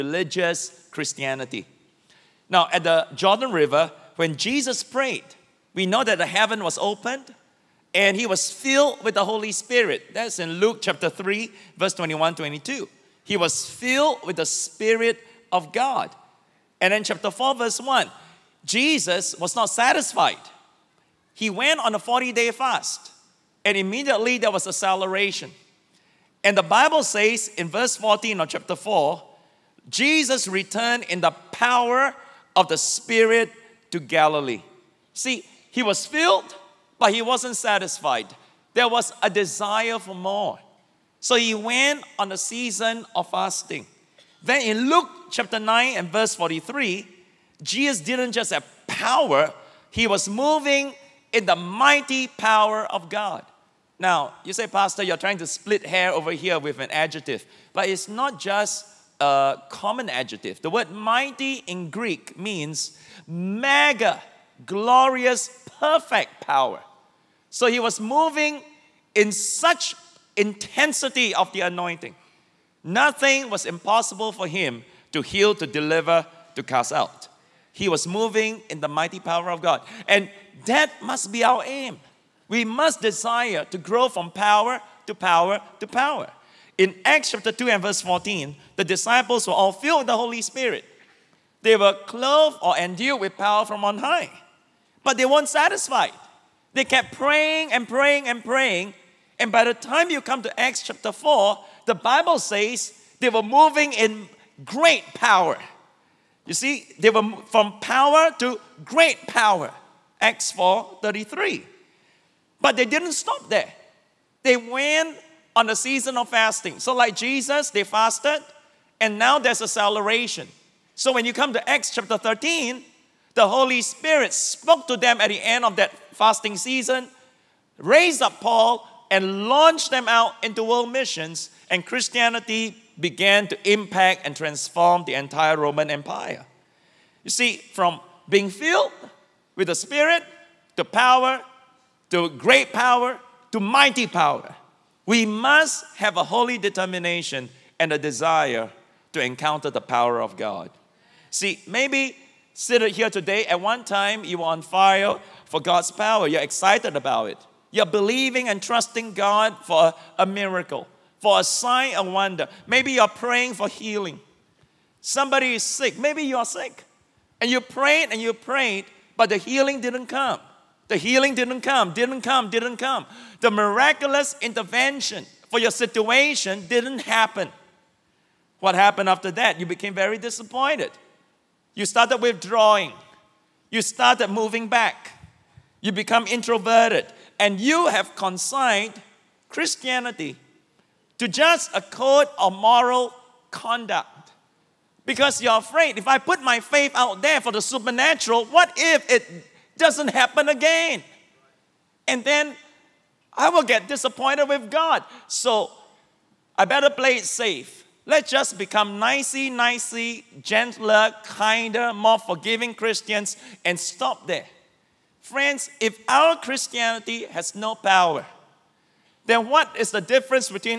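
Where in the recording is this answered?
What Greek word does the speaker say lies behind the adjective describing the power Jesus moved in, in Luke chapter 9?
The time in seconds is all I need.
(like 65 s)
63 s.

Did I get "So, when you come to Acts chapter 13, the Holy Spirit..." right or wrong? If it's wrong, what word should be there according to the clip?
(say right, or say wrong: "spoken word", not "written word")
right.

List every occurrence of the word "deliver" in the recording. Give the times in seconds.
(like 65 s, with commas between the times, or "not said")
75 s.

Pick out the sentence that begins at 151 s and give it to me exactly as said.
See, maybe Sit here today, at one time you were on fire for God's power.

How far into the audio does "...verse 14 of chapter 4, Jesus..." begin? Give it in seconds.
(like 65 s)
27 s.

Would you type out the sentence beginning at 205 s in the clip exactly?
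So I better play it safe.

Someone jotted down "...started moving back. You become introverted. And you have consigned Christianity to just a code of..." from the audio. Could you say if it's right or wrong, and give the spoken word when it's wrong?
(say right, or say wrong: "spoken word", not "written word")
right.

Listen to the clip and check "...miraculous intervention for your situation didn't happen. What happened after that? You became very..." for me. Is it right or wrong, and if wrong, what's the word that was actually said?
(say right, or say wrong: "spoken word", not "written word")
right.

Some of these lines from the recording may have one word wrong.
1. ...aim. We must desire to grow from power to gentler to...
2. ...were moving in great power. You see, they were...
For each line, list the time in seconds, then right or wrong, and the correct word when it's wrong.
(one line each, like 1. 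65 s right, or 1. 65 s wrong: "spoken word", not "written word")
1. 81 s wrong: "power", not "gentler"
2. 103 s right.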